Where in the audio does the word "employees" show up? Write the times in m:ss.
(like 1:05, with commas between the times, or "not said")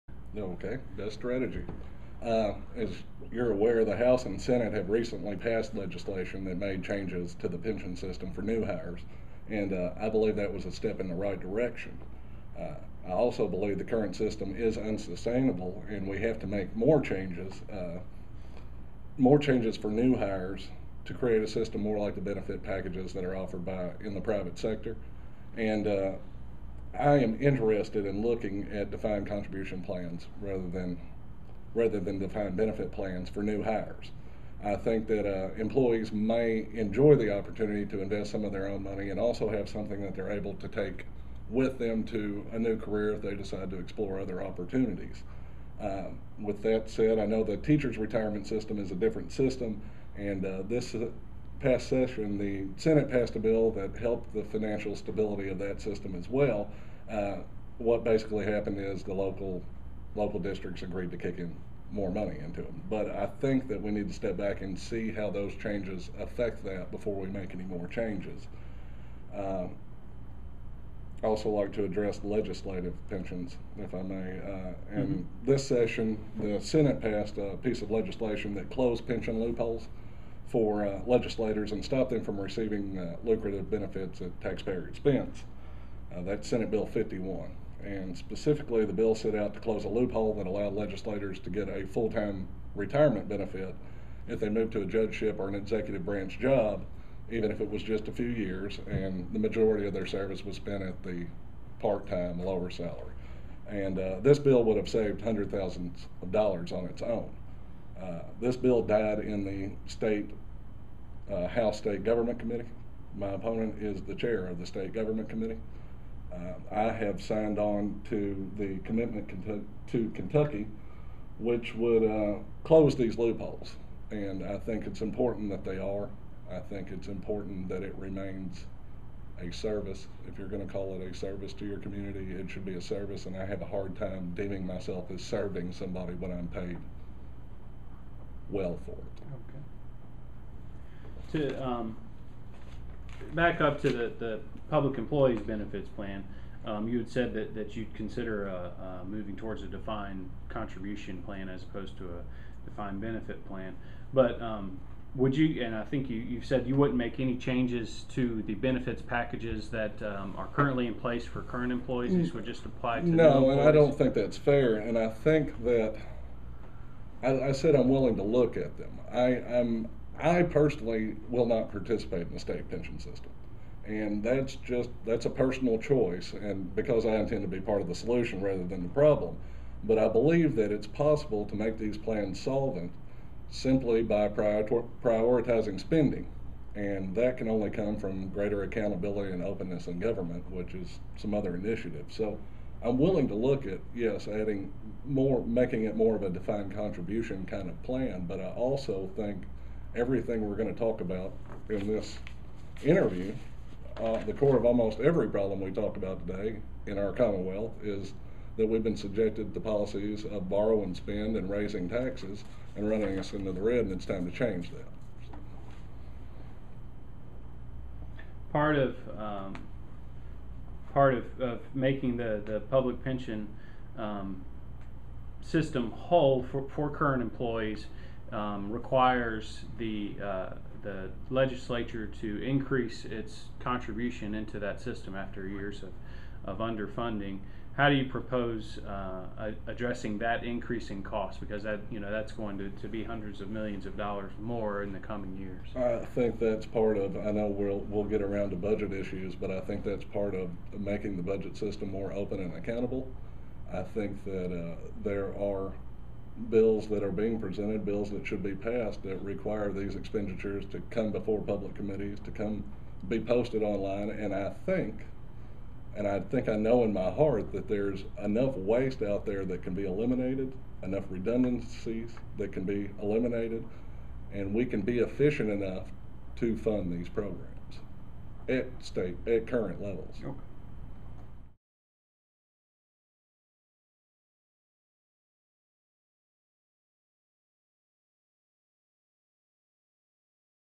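0:35, 2:24, 2:41, 3:47.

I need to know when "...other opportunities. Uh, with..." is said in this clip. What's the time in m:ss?
0:44.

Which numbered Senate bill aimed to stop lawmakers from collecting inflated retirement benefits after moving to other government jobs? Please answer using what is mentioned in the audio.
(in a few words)
Senate Bill 51.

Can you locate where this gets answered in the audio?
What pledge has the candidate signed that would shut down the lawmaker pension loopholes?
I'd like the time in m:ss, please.
1:58.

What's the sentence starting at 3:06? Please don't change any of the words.
And that can only come from greater accountability and openness in government, which is some other initiative.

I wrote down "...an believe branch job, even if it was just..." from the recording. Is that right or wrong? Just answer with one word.
wrong.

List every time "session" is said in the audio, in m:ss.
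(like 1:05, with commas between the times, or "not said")
0:51, 1:15.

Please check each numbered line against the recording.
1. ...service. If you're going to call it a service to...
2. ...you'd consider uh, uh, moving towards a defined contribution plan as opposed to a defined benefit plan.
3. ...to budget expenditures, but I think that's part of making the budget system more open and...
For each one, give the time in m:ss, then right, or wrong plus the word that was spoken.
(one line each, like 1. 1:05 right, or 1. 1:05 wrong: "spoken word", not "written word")
1. 2:09 right
2. 2:27 right
3. 4:08 wrong: "issues", not "expenditures".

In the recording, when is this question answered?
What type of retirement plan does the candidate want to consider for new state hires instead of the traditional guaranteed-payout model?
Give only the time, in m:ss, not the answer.
0:28.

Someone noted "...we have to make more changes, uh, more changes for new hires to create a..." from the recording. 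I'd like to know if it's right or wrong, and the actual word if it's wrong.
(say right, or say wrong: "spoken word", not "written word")
right.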